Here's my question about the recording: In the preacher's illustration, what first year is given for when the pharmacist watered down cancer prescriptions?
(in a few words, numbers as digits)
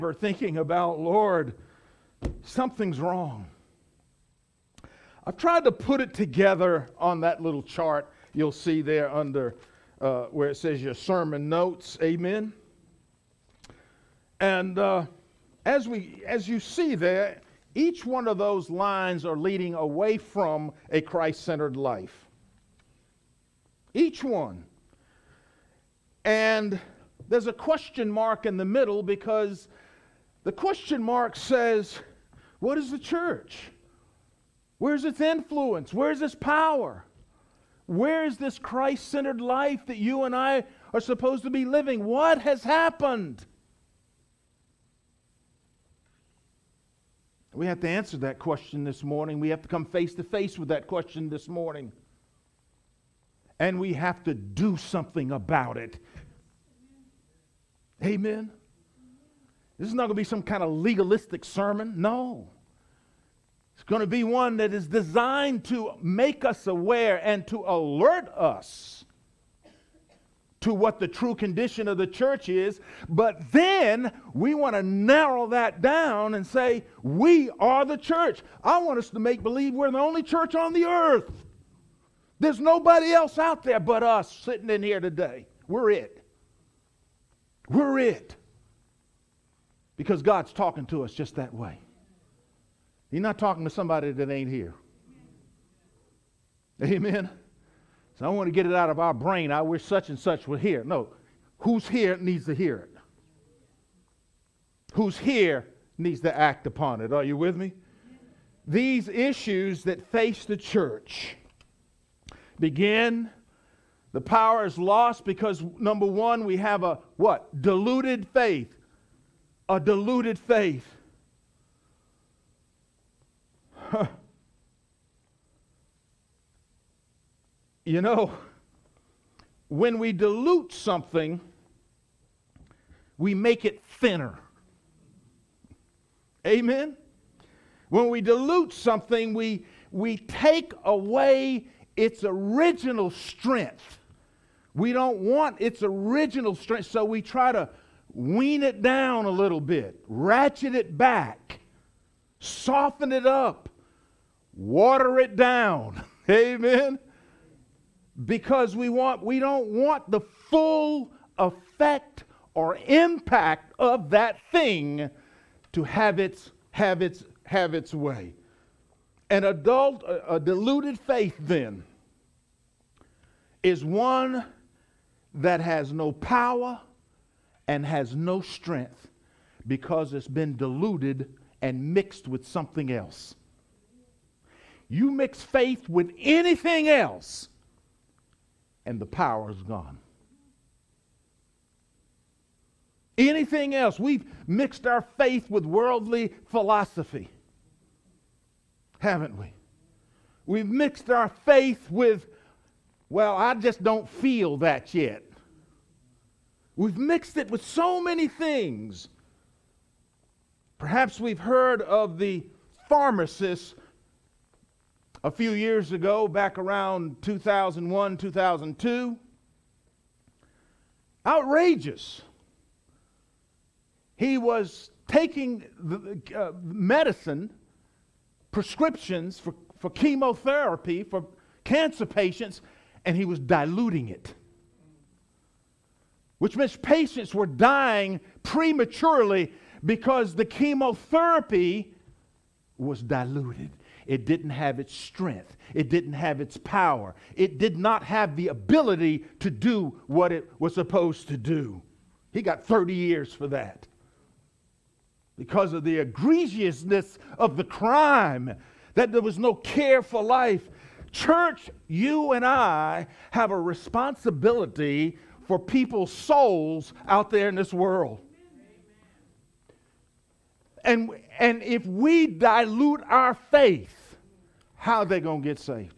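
2001.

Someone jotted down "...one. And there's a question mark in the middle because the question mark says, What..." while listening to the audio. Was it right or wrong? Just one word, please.
right.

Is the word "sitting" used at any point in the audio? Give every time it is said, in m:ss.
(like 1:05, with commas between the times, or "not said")
1:24.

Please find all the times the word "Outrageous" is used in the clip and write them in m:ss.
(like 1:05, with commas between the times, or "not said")
3:41.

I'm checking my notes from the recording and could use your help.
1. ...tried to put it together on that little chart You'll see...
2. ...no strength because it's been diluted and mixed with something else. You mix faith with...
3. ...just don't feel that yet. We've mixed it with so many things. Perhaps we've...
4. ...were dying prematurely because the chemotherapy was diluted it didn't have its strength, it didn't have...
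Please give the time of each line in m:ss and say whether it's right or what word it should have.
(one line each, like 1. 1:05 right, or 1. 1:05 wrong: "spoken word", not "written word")
1. 0:05 right
2. 2:58 right
3. 3:23 right
4. 3:57 right.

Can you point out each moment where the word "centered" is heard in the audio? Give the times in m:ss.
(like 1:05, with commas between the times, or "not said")
0:21, 0:39.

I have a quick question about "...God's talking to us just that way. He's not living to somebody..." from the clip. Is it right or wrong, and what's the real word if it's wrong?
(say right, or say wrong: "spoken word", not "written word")
wrong: "talking", not "living".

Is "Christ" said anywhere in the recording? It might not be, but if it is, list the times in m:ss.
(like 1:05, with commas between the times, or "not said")
0:21, 0:38.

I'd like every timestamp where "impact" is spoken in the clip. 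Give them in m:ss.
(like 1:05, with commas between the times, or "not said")
2:42.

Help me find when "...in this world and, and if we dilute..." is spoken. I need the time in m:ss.
4:27.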